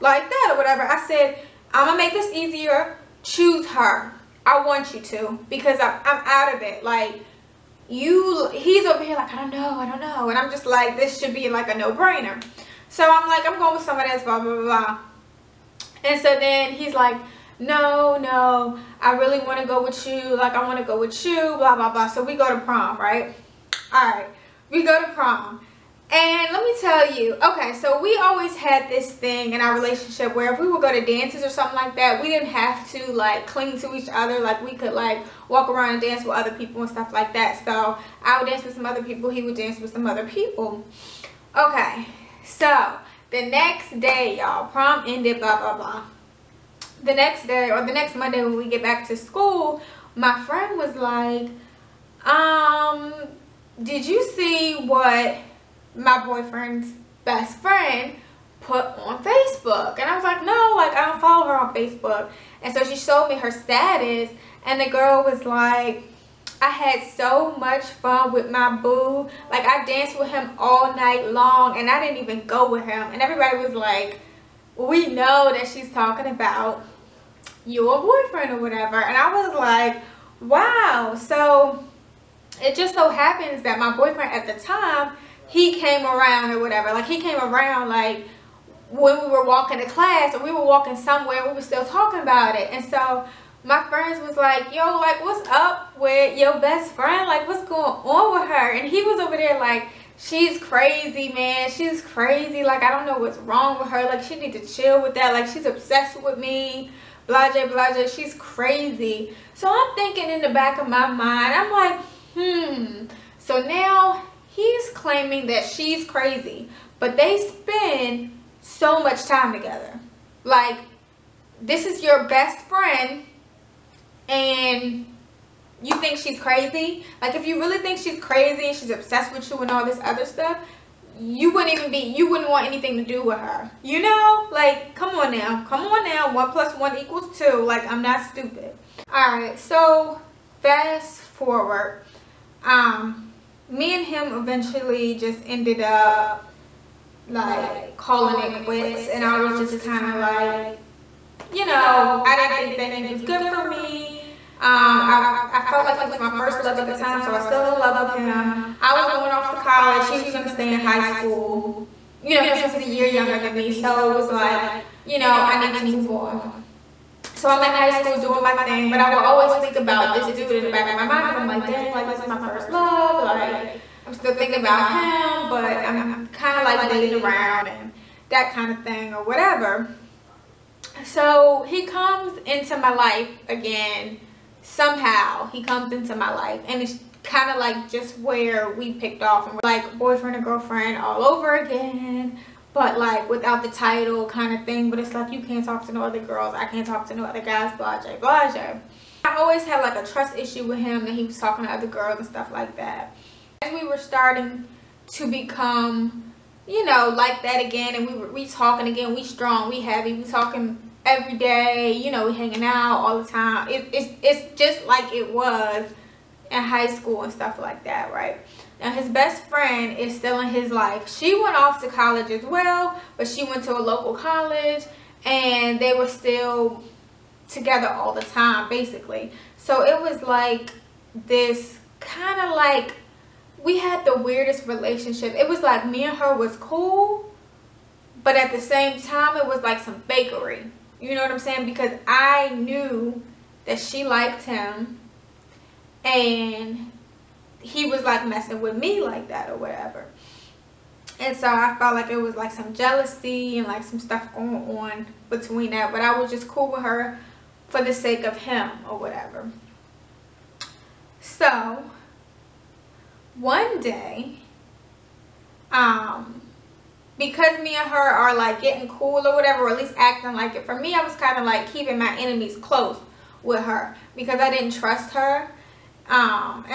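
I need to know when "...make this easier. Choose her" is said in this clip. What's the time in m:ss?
0:02.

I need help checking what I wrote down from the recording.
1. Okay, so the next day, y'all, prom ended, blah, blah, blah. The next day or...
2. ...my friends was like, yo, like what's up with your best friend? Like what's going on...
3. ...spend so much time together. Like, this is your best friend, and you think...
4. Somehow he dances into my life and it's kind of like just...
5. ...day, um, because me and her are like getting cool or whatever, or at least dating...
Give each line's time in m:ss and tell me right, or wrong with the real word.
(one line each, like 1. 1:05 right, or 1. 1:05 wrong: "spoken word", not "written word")
1. 0:41 right
2. 1:33 right
3. 1:57 right
4. 3:04 wrong: "comes", not "dances"
5. 4:23 wrong: "acting", not "dating".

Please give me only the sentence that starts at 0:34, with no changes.
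Like we could like walk around and dance with other people and stuff like that.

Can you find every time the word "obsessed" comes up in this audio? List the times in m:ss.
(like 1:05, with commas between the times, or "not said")
1:45, 2:08.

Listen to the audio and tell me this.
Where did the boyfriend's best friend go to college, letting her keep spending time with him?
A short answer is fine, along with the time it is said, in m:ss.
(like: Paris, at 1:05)
local college, at 3:43.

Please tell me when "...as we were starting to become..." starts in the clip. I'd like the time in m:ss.
3:23.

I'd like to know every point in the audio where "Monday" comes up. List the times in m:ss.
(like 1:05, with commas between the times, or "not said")
0:48.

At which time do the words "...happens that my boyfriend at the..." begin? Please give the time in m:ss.
1:23.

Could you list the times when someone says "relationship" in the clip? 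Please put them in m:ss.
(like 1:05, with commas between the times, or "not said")
0:29, 3:54.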